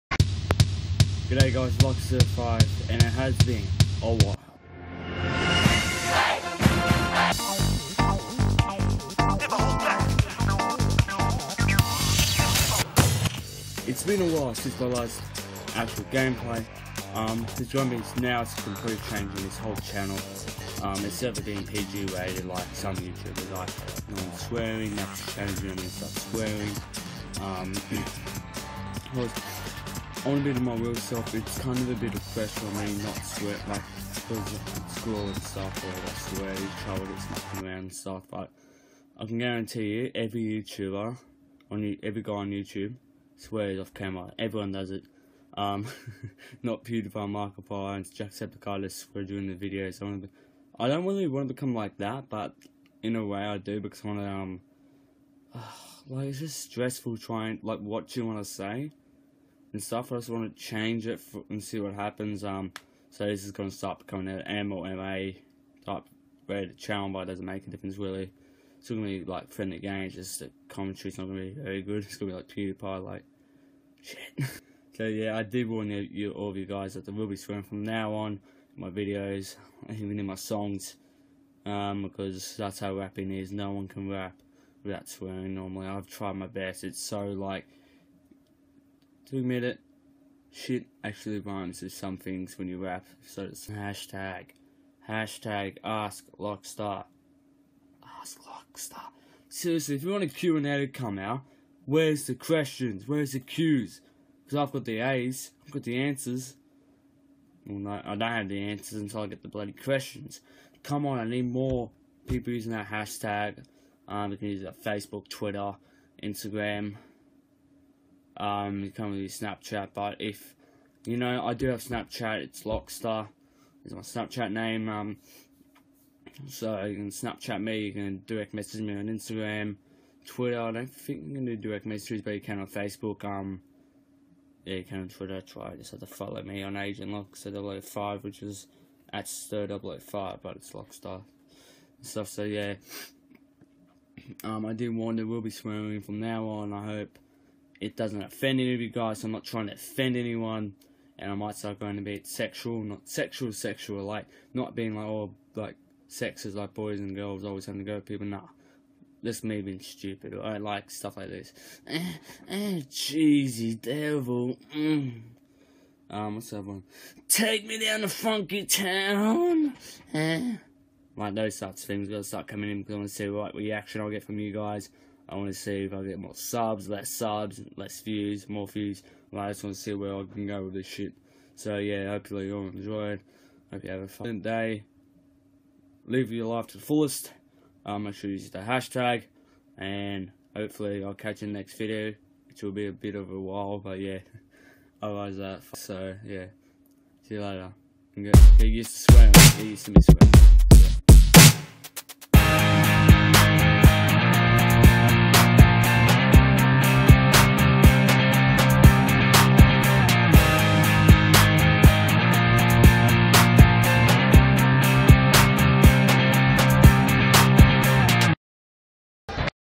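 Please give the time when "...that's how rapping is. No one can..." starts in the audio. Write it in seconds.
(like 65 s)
82 s.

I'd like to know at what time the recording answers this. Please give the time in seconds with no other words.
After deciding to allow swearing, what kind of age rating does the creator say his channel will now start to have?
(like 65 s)
64 s.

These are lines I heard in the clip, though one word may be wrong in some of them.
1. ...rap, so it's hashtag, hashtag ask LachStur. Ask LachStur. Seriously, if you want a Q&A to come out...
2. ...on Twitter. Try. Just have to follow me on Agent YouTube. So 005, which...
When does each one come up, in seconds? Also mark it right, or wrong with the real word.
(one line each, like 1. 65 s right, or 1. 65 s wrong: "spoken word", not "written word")
1. 92 s right
2. 135 s wrong: "Lock", not "YouTube".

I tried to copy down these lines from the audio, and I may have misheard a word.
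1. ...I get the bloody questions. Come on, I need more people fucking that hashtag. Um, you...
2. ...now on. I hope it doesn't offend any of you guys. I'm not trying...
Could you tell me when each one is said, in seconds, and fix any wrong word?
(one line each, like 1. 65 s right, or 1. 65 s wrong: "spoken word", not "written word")
1. 109 s wrong: "using", not "fucking"
2. 146 s right.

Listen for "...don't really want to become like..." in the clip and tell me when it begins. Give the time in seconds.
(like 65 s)
50 s.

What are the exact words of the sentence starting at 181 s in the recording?
So yeah, hopefully you all enjoyed.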